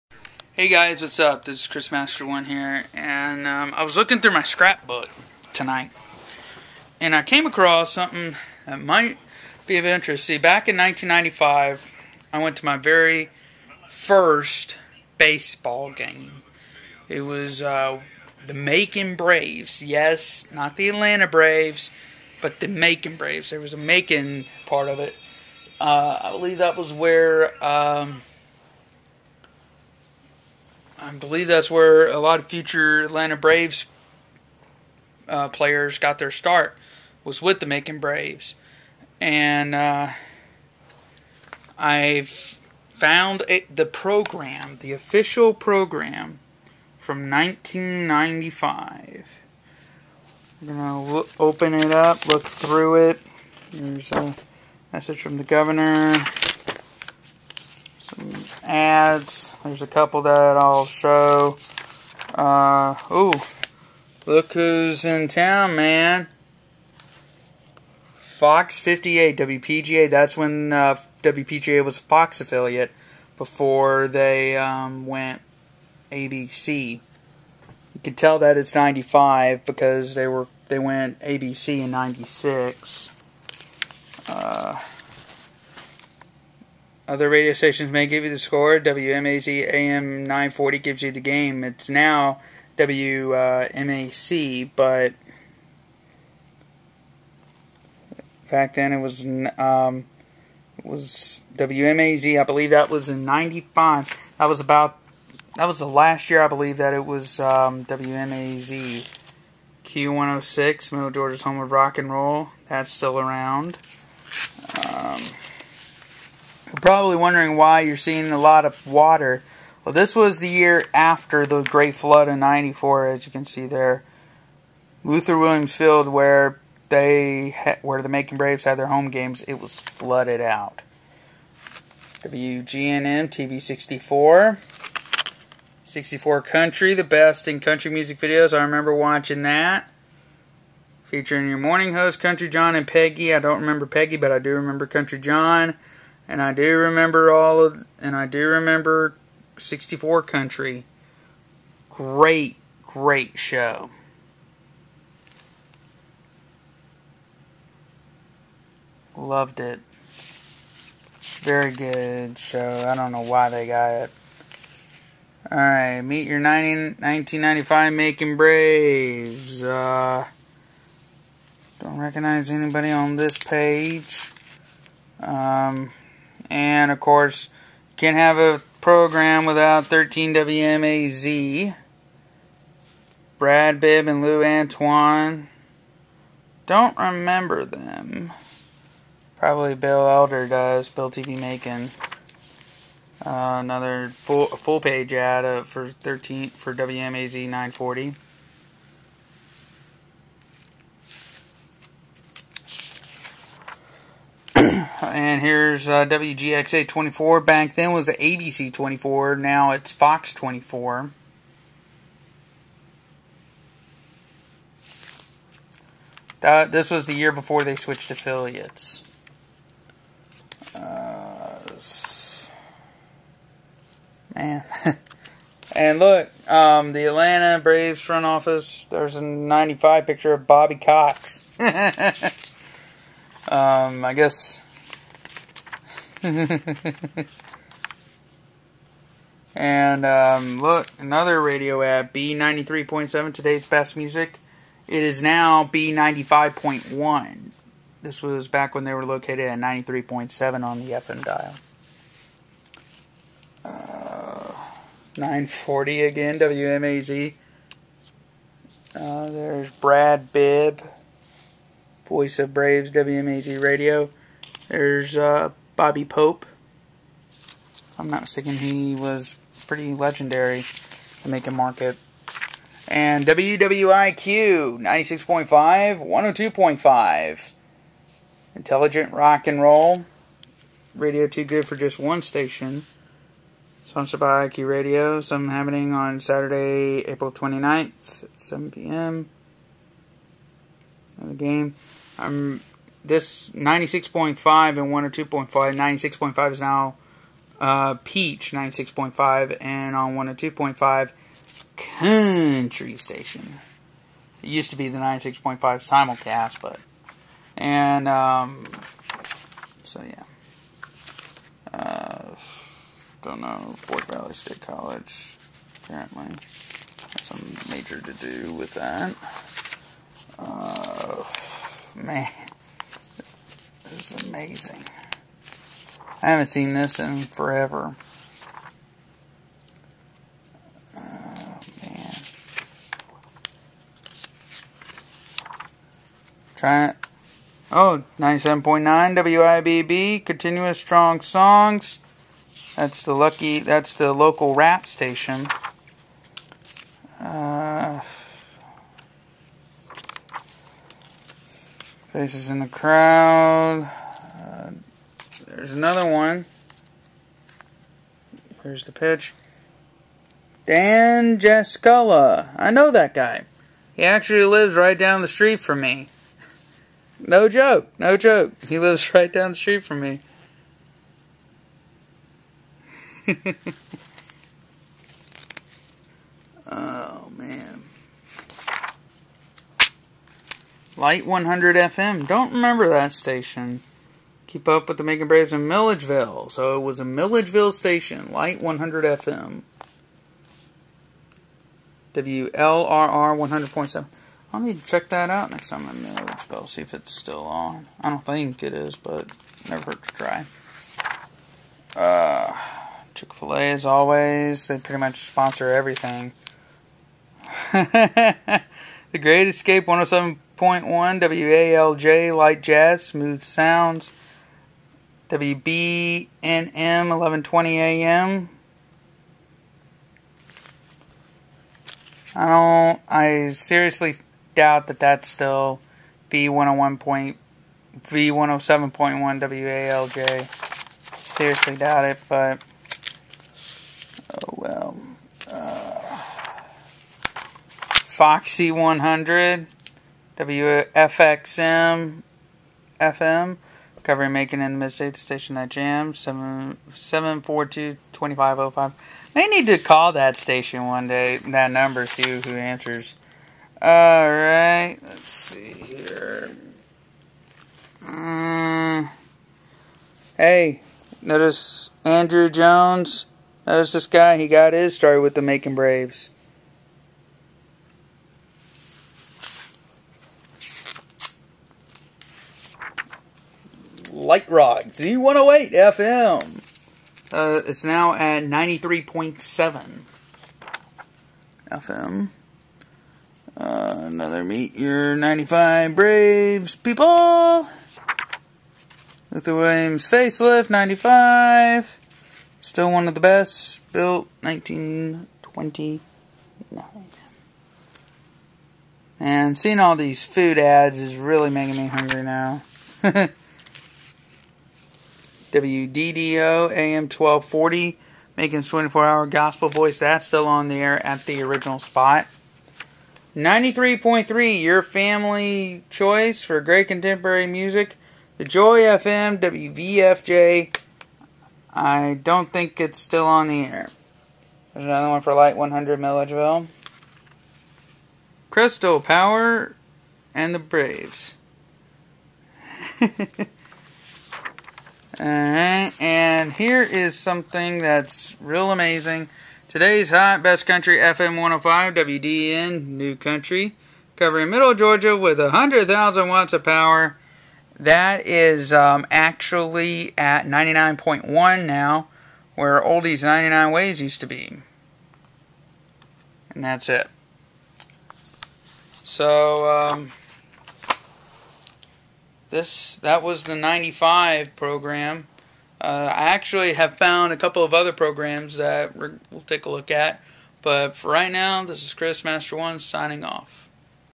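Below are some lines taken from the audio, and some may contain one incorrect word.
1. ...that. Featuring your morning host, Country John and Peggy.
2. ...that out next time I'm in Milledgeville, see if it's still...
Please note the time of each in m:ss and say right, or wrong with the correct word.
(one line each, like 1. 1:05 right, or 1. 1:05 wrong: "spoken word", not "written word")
1. 2:19 right
2. 6:35 right.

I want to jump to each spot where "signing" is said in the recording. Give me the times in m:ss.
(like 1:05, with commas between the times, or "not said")
9:32.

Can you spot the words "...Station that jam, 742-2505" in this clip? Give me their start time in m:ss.
7:25.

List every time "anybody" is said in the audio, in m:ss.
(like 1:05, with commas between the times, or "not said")
2:52.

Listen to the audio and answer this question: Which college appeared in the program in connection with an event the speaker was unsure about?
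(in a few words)
Fort Valley State College.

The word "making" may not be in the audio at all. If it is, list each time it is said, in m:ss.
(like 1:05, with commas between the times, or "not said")
3:11, 8:21, 8:28.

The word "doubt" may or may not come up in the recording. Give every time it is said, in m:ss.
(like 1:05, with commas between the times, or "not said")
7:04, 7:11.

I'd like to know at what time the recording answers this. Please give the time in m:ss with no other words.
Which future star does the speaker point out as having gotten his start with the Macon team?
7:42.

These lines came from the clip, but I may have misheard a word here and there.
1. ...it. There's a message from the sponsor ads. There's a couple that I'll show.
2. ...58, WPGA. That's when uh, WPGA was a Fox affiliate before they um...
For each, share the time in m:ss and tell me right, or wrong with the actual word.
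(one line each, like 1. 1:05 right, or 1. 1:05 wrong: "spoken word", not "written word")
1. 0:53 wrong: "governor", not "sponsor"
2. 1:08 right.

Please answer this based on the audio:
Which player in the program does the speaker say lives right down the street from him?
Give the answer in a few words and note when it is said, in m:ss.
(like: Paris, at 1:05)
Dan Jaskula, at 6:00.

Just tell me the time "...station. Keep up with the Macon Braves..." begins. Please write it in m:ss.
6:23.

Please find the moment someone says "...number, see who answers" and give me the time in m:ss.
7:31.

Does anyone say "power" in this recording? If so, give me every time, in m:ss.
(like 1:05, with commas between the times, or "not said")
8:48, 9:06.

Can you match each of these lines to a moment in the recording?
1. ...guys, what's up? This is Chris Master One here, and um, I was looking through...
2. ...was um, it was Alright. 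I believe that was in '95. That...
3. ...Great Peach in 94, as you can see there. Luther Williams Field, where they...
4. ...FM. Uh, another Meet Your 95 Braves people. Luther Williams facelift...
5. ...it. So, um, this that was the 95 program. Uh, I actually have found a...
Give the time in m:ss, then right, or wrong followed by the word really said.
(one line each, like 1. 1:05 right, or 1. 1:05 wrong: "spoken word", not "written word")
1. 0:00 right
2. 1:39 wrong: "WMAZ", not "Alright"
3. 2:01 wrong: "Flood", not "Peach"
4. 8:01 right
5. 9:16 right.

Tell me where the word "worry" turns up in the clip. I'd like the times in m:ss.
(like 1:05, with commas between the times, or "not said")
not said.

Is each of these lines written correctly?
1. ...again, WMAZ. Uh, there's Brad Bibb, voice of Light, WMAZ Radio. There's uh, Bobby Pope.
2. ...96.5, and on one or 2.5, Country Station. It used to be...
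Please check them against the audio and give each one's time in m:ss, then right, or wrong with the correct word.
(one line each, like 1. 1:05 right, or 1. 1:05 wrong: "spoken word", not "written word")
1. 4:16 wrong: "Braves", not "Light"
2. 4:58 right.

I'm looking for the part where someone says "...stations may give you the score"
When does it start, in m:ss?
1:27.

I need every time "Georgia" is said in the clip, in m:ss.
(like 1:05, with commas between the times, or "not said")
1:51, 9:04.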